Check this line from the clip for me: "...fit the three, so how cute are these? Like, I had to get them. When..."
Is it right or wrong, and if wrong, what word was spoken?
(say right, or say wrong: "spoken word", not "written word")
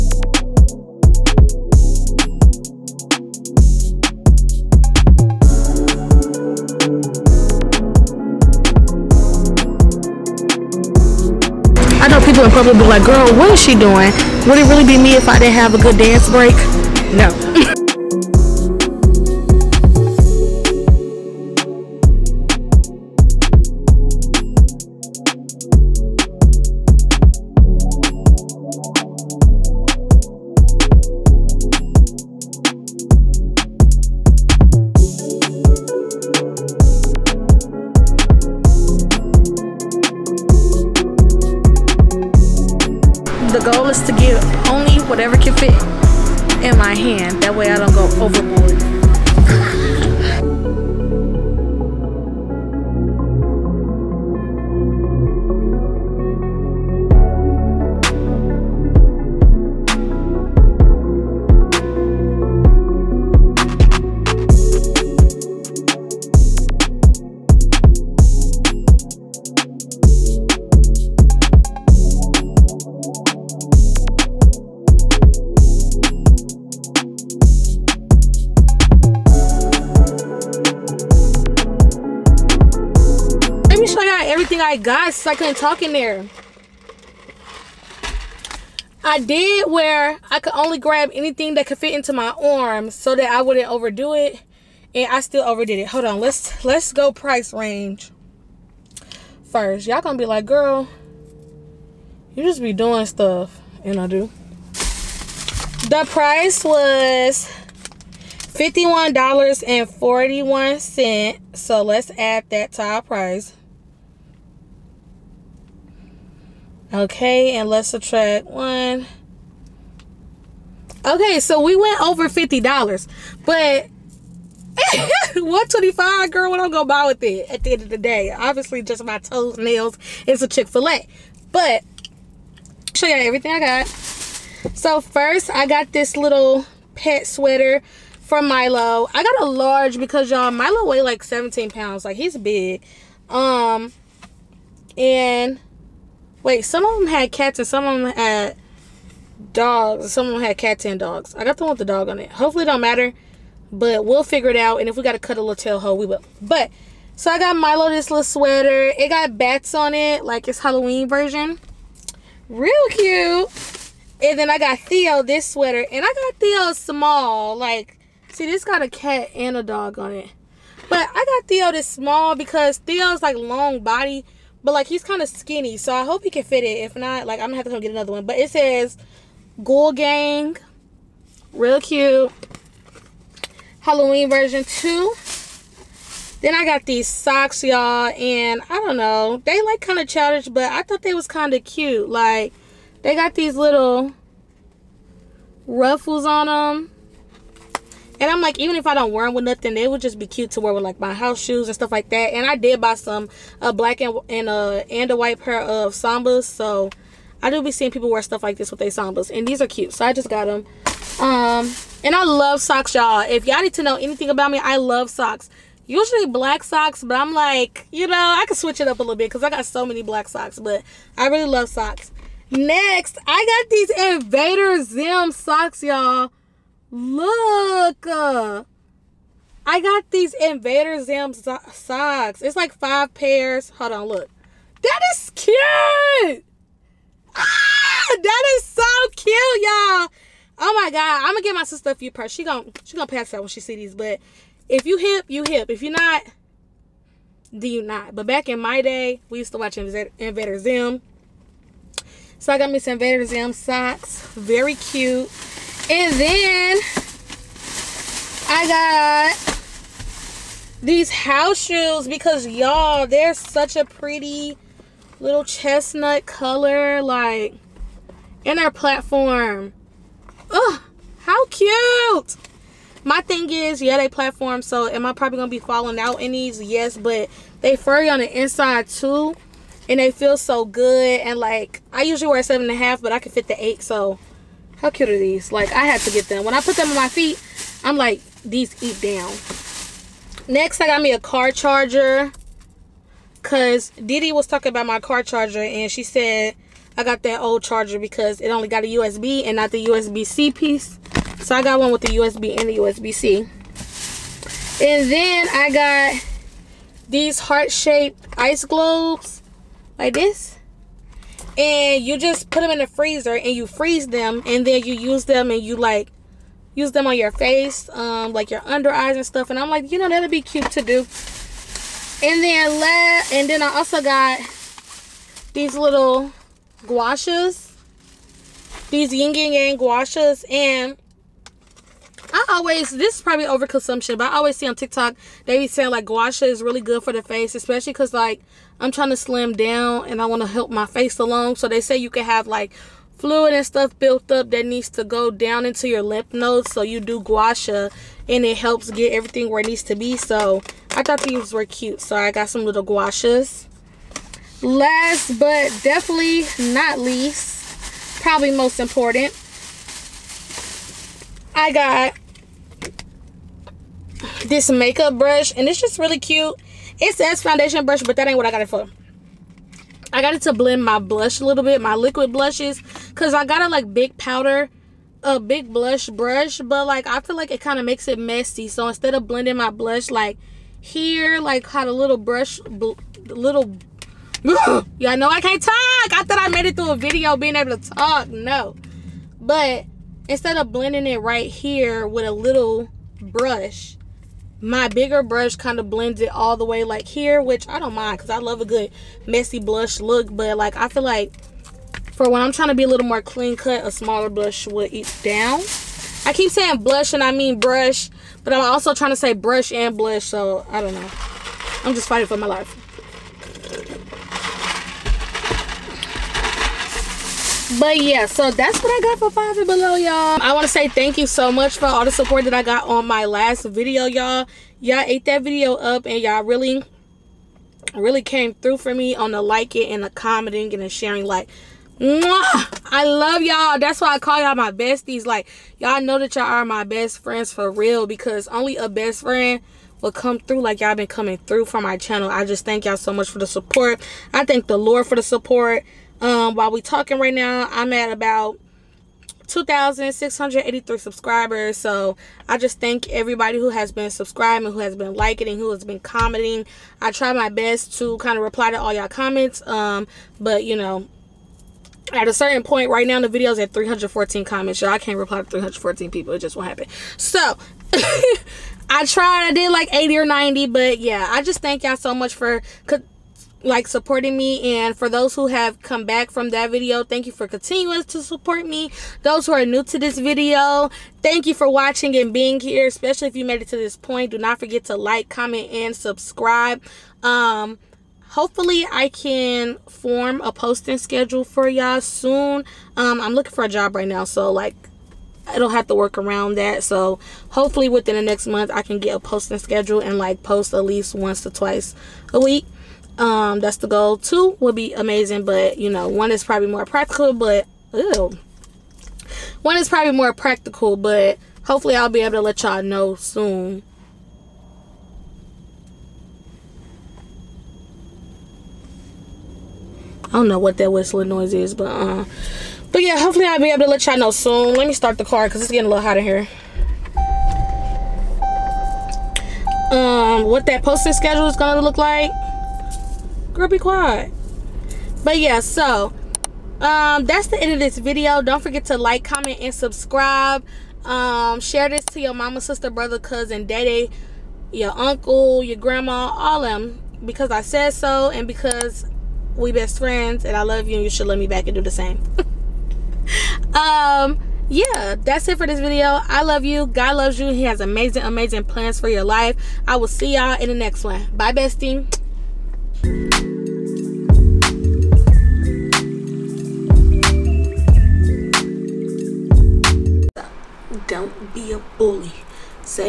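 wrong: "eight", not "three".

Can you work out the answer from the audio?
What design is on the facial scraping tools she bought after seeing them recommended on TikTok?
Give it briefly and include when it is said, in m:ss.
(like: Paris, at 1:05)
Yin yang, at 5:29.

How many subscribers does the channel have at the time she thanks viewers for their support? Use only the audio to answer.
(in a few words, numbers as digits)
2,683.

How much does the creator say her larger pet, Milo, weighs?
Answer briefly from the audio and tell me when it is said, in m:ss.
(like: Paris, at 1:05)
17 pounds, at 2:21.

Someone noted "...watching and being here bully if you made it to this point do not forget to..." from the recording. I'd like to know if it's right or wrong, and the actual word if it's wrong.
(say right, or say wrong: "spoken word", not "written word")
wrong: "especially", not "bully".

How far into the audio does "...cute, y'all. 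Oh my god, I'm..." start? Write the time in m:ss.
3:59.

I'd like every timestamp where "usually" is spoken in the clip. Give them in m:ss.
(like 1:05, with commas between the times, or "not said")
3:35, 4:42.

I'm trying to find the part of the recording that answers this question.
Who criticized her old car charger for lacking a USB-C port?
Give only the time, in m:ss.
4:53.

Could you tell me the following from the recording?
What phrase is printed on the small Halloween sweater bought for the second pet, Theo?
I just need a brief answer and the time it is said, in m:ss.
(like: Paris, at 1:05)
Ghoul Gang, at 2:59.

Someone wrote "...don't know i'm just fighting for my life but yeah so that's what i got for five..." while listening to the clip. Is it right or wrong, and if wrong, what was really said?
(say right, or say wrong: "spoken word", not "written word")
right.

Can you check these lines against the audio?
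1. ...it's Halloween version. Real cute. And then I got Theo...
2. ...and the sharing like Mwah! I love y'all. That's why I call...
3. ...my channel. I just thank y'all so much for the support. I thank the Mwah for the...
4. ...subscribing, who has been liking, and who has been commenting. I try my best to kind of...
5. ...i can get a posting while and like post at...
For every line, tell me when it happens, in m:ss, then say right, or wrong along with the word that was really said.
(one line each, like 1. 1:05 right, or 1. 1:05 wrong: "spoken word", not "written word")
1. 2:40 right
2. 7:10 right
3. 7:21 wrong: "Lord", not "Mwah"
4. 7:34 right
5. 8:18 wrong: "schedule", not "while".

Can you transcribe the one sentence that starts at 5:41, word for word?
So they say you can have like fluid and stuff built up that needs to go down into your lymph nodes.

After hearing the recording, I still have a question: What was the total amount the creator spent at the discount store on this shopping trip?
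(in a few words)
$51.41.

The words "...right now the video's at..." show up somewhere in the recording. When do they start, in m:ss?
7:42.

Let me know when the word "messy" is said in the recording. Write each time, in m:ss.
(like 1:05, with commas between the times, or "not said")
6:18, 6:39.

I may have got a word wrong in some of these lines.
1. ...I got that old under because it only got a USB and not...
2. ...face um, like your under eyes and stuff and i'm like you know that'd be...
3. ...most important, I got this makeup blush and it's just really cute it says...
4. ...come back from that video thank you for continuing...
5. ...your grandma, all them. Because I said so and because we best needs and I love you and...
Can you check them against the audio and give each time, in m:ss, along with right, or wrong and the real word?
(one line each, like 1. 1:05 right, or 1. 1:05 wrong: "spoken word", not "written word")
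1. 4:56 wrong: "charger", not "under"
2. 5:17 right
3. 5:58 wrong: "brush", not "blush"
4. 7:55 right
5. 9:05 wrong: "friends", not "needs".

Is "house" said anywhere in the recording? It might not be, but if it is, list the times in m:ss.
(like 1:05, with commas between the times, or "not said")
3:21, 4:21.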